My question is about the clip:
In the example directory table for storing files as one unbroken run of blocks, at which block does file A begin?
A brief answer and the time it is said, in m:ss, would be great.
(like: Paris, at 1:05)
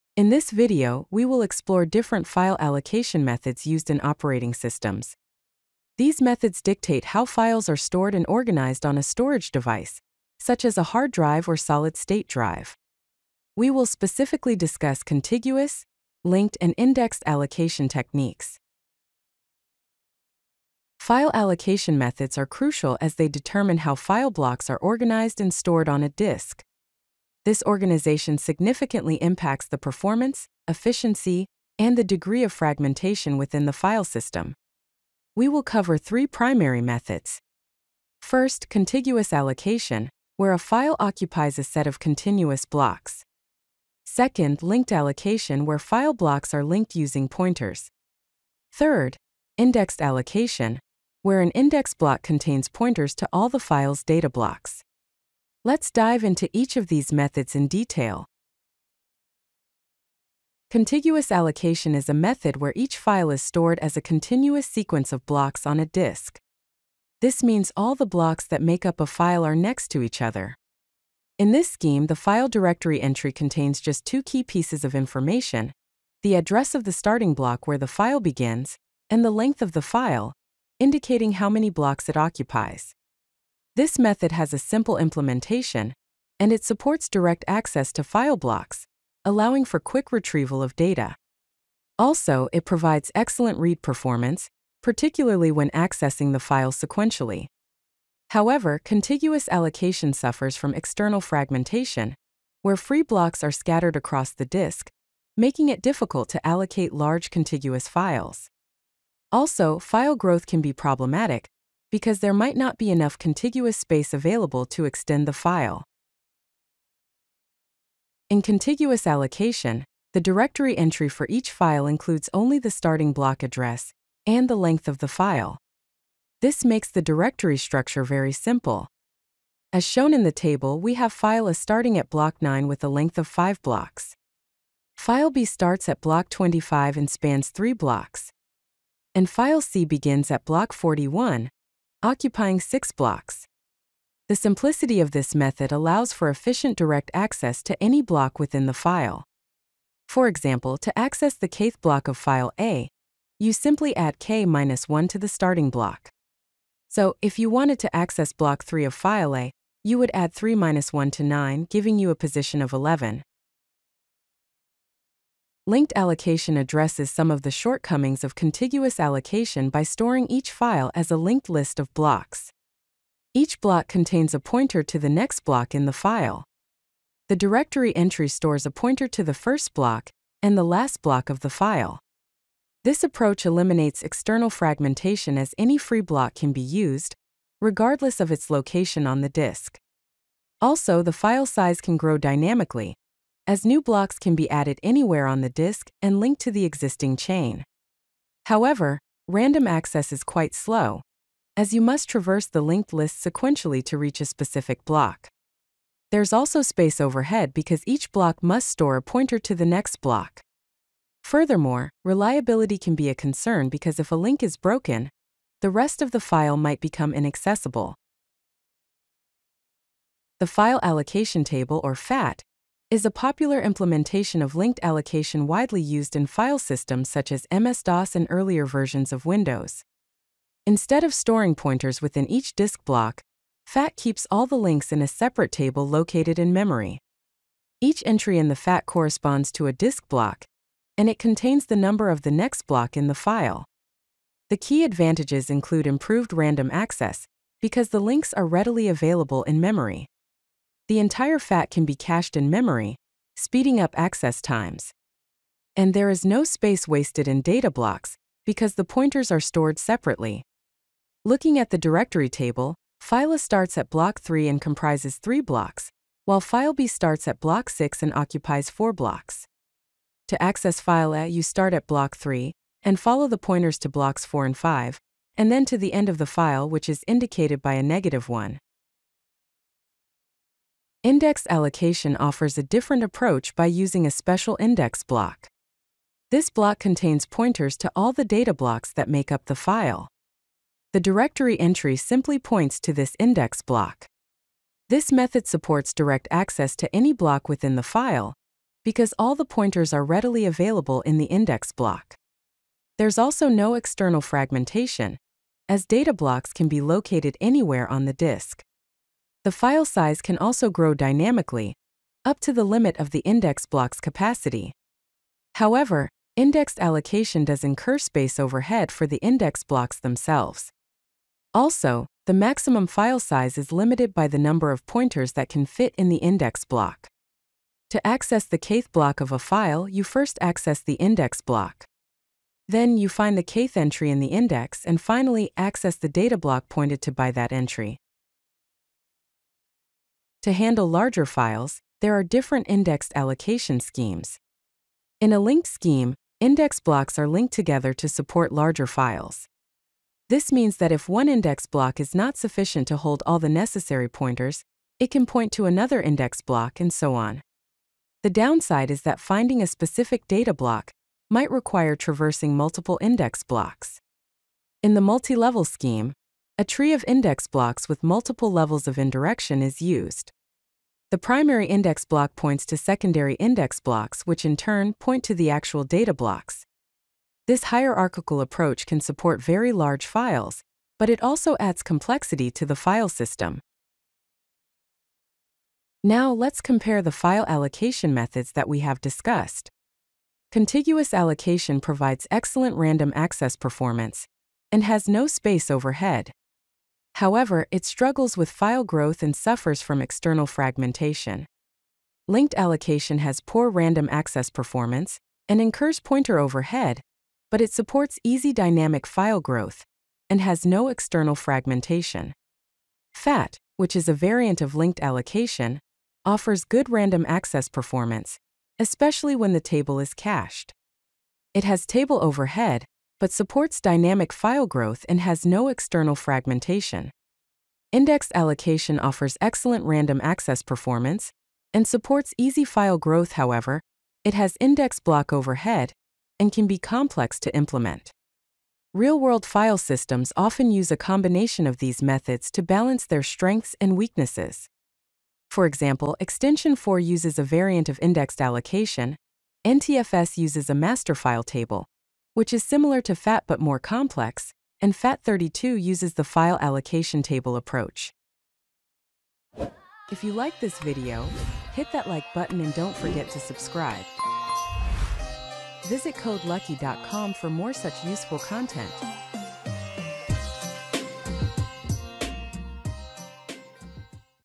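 9, at 2:12.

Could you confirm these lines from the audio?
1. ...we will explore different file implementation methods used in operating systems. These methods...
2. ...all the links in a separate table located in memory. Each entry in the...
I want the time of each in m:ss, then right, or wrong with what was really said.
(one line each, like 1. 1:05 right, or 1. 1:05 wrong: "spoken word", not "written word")
1. 0:01 wrong: "allocation", not "implementation"
2. 3:54 right.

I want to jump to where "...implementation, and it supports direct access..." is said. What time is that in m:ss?
1:24.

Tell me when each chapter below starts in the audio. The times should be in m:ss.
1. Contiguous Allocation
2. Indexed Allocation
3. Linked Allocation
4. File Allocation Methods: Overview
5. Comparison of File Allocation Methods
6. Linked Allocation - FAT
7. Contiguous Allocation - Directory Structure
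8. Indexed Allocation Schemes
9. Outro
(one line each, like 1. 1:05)
1. 0:59
2. 4:39
3. 2:44
4. 0:19
5. 6:24
6. 3:39
7. 1:57
8. 5:39
9. 7:39.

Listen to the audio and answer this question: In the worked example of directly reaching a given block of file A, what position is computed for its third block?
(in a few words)
11.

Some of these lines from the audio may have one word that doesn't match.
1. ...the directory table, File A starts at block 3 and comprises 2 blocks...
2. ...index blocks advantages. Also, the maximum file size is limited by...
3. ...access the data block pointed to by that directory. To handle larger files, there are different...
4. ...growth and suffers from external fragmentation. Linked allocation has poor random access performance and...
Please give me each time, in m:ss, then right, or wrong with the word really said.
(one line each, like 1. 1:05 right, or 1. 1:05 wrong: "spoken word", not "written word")
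1. 4:21 wrong: "3", not "2"
2. 5:19 wrong: "themselves", not "advantages"
3. 5:35 wrong: "entry", not "directory"
4. 6:38 right.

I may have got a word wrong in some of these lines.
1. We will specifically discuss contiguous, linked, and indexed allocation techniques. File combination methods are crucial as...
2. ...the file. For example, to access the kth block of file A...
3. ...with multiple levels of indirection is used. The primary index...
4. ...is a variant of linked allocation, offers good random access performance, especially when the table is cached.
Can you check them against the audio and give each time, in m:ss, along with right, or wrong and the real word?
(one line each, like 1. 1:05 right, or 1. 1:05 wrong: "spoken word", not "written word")
1. 0:13 wrong: "allocation", not "combination"
2. 2:28 right
3. 6:07 right
4. 6:53 right.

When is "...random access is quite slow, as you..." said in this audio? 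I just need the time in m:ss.
3:19.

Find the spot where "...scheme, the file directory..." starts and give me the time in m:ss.
1:11.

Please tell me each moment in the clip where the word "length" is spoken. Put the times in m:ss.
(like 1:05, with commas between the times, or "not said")
1:19, 2:04, 2:12.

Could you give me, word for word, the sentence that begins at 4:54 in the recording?
This method supports direct access to any block within the file, because all the pointers are readily available in the index block.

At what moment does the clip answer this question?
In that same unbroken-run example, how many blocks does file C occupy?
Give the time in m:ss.
2:22.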